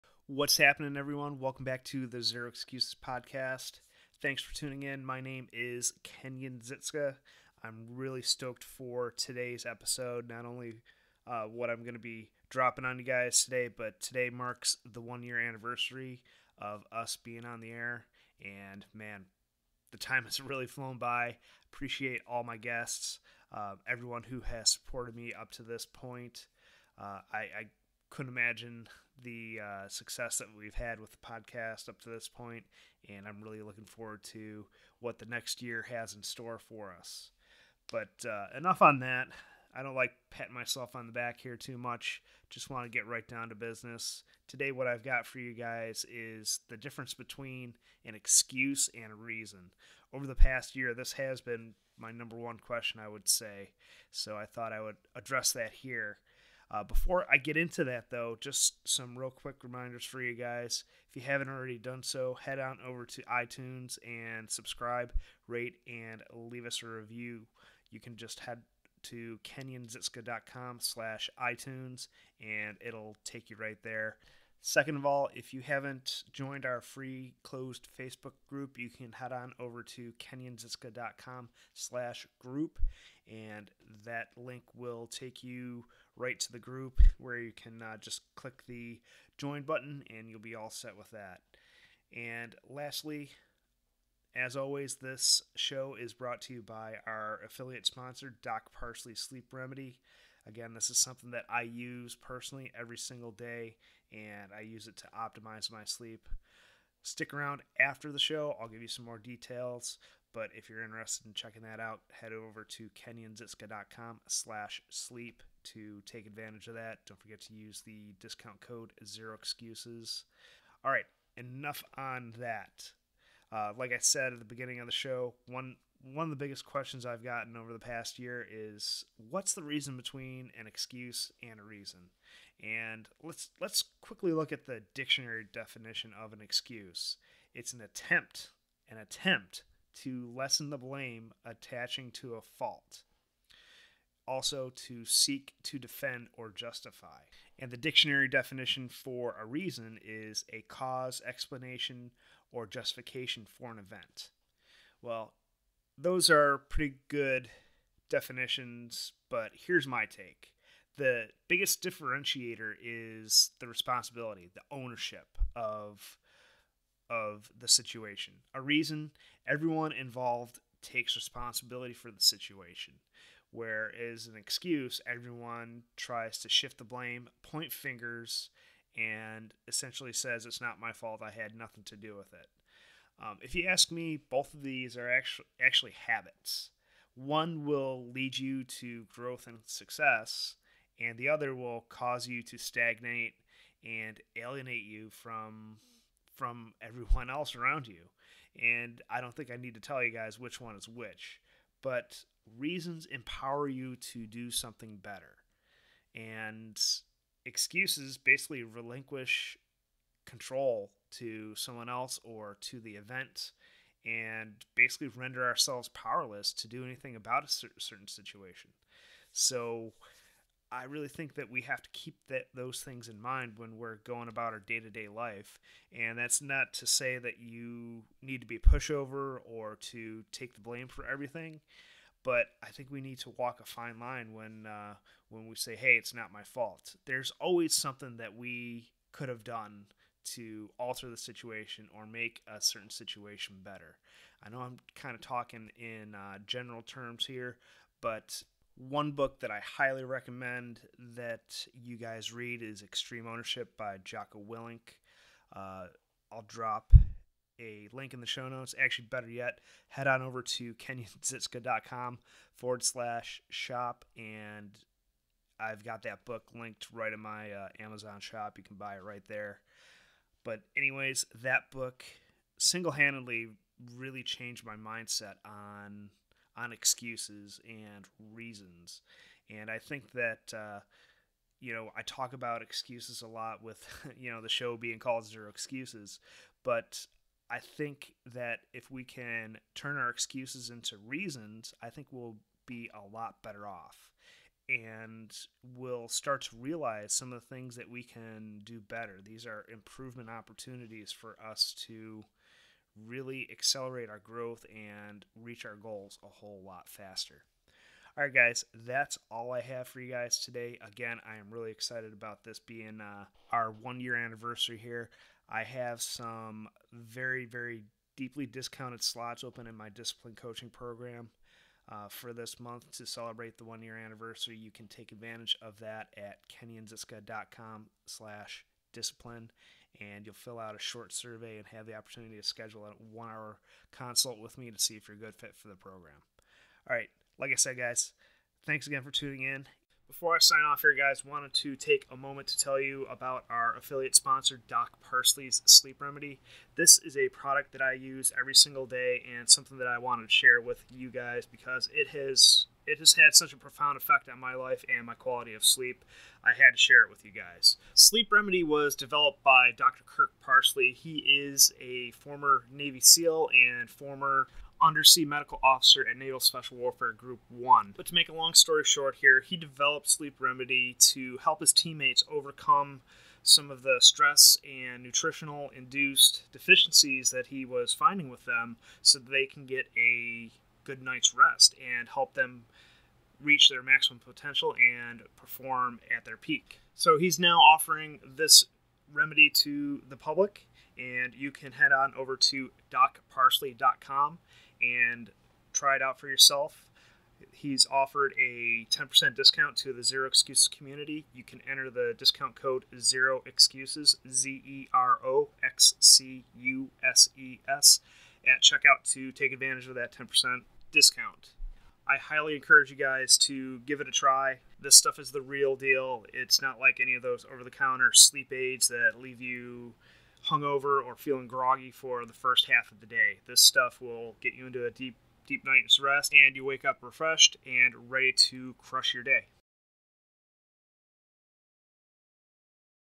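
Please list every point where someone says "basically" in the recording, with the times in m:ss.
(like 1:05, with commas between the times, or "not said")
3:28, 3:34.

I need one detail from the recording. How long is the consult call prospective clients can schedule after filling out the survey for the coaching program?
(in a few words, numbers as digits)
one hour.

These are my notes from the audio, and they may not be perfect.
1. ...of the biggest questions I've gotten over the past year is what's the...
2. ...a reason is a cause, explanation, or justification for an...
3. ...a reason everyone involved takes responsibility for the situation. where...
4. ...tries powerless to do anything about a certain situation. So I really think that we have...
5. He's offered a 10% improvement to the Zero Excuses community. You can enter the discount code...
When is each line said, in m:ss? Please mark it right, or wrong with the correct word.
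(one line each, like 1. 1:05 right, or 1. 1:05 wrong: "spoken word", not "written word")
1. 2:06 right
2. 2:29 right
3. 2:48 right
4. 3:35 wrong: "ourselves", not "tries"
5. 6:37 wrong: "discount", not "improvement".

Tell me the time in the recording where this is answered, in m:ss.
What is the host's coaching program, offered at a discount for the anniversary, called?
5:19.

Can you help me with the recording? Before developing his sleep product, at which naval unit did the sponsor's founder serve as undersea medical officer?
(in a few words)
Naval Special Warfare Group 1.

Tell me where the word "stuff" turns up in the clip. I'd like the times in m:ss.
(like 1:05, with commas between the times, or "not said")
6:54, 7:03.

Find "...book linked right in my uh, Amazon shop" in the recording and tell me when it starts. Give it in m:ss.
4:26.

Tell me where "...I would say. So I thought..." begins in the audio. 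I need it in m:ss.
0:52.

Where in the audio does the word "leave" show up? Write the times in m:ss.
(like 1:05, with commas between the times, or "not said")
1:06, 6:59.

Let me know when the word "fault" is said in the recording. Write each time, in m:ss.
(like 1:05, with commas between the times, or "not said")
2:22, 3:00, 3:56.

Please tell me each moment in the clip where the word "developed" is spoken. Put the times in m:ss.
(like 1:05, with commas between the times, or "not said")
5:58, 6:09.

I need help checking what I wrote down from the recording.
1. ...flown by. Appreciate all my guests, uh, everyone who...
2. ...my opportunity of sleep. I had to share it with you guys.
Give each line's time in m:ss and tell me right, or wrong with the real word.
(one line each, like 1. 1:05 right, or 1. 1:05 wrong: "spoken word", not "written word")
1. 0:20 right
2. 5:55 wrong: "quality", not "opportunity".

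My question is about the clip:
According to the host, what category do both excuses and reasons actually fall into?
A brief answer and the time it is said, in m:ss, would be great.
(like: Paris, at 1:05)
habits, at 3:05.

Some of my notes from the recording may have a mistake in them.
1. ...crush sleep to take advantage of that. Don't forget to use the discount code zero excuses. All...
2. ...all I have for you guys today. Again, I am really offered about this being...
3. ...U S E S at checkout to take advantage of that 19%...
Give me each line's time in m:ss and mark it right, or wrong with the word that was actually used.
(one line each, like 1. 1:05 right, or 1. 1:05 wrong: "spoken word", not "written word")
1. 1:54 wrong: "slash", not "crush"
2. 5:09 wrong: "excited", not "offered"
3. 6:46 wrong: "10", not "19".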